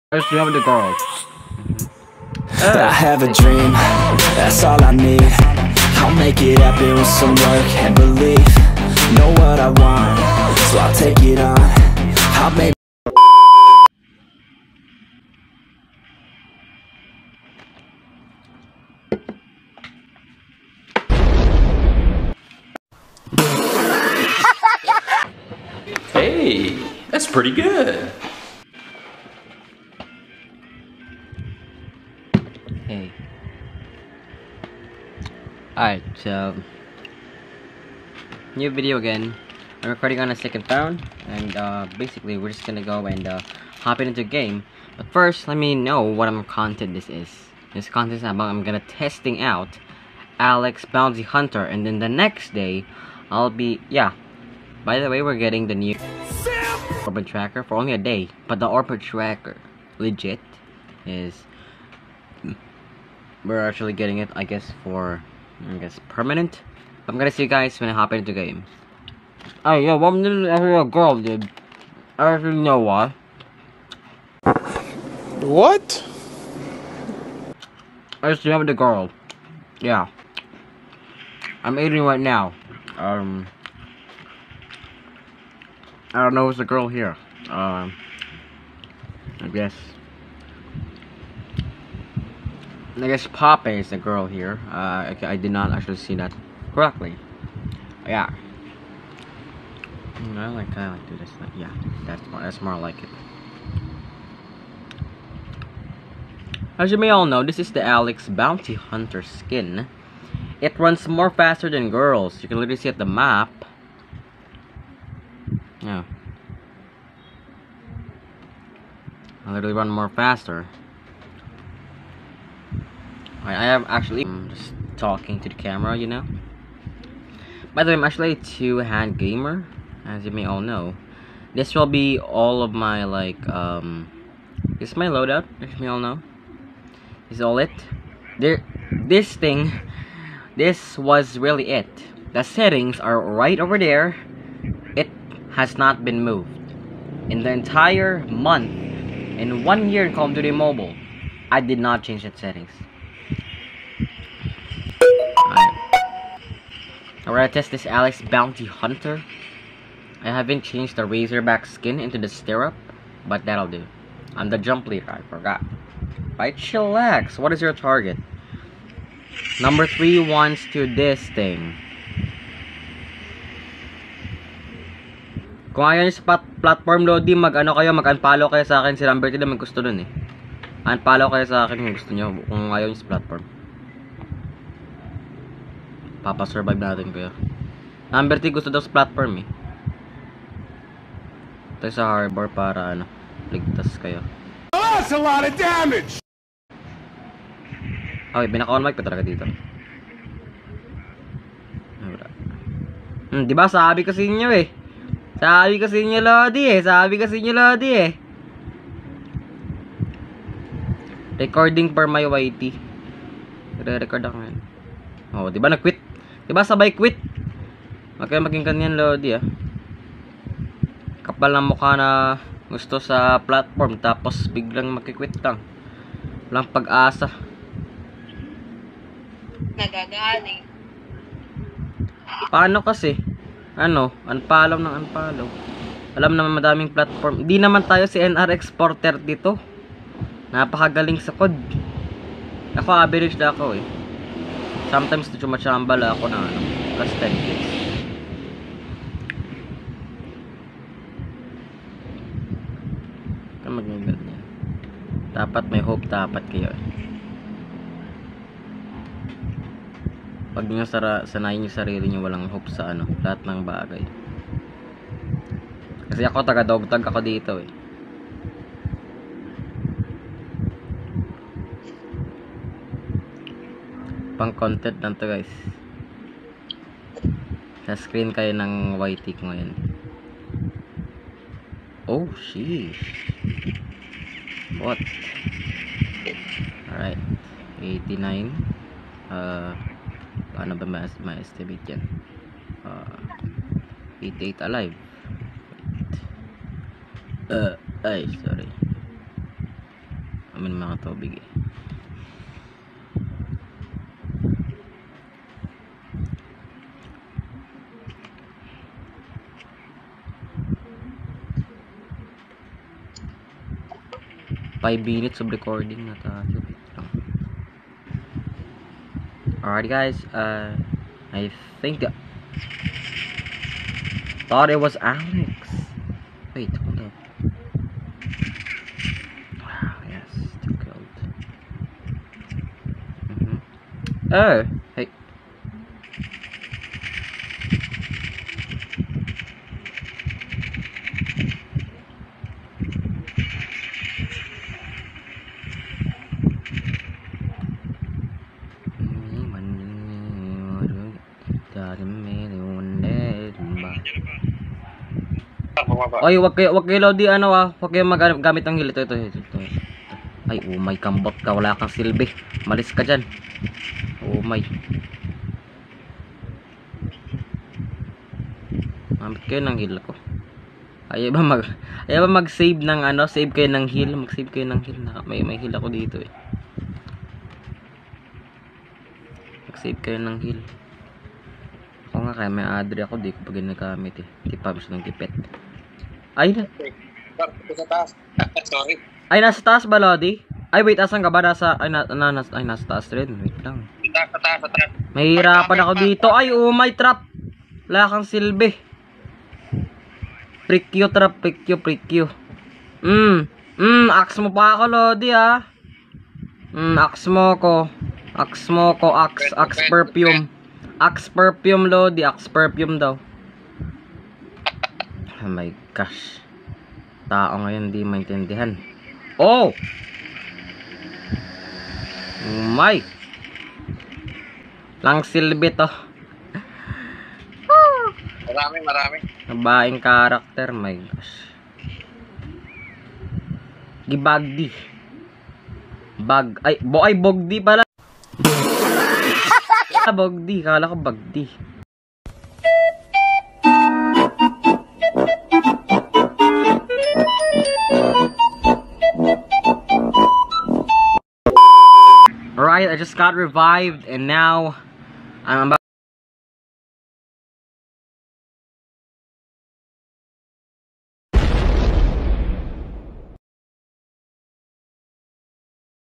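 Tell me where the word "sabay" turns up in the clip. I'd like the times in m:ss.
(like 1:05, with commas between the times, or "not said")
3:36.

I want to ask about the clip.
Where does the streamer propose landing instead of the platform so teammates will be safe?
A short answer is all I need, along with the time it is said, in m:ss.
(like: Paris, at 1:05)
Harbor, at 3:12.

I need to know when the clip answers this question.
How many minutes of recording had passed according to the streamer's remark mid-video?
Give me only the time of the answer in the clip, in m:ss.
5:14.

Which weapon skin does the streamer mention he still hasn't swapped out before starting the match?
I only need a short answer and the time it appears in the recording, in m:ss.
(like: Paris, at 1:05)
Razorback, at 2:41.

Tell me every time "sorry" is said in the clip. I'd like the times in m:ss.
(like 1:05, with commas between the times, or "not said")
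4:58, 6:28.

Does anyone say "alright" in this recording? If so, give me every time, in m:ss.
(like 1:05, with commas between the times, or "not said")
0:35, 4:46, 5:19, 7:32.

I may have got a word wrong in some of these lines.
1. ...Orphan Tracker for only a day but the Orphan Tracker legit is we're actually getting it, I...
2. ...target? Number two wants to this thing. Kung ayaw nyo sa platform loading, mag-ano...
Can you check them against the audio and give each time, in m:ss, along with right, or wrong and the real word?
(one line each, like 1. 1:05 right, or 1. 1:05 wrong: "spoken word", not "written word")
1. 0:57 right
2. 2:47 wrong: "three", not "two".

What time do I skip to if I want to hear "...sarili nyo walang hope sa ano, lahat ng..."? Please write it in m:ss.
4:21.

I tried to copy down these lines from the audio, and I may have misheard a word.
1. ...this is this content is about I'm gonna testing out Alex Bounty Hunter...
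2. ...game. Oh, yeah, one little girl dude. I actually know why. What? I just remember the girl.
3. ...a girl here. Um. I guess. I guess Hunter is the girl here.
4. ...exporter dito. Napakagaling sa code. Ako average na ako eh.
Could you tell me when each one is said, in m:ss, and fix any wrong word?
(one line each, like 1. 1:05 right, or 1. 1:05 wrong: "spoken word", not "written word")
1. 0:46 right
2. 1:08 right
3. 1:26 wrong: "Poppy", not "Hunter"
4. 3:58 right.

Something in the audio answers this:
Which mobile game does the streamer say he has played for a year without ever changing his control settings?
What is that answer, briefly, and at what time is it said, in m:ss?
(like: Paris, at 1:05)
Call of Duty Mobile, at 2:30.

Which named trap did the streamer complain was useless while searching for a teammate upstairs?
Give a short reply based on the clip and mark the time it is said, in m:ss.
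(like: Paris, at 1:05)
Prikyo trap, at 6:40.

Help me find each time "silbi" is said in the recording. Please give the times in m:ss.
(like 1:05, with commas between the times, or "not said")
6:01, 6:38, 7:05.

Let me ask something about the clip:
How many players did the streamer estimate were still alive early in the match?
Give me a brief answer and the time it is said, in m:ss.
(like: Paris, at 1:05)
88, at 4:54.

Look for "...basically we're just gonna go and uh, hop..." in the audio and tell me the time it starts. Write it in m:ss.
0:41.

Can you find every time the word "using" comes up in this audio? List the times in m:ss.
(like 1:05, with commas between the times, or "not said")
not said.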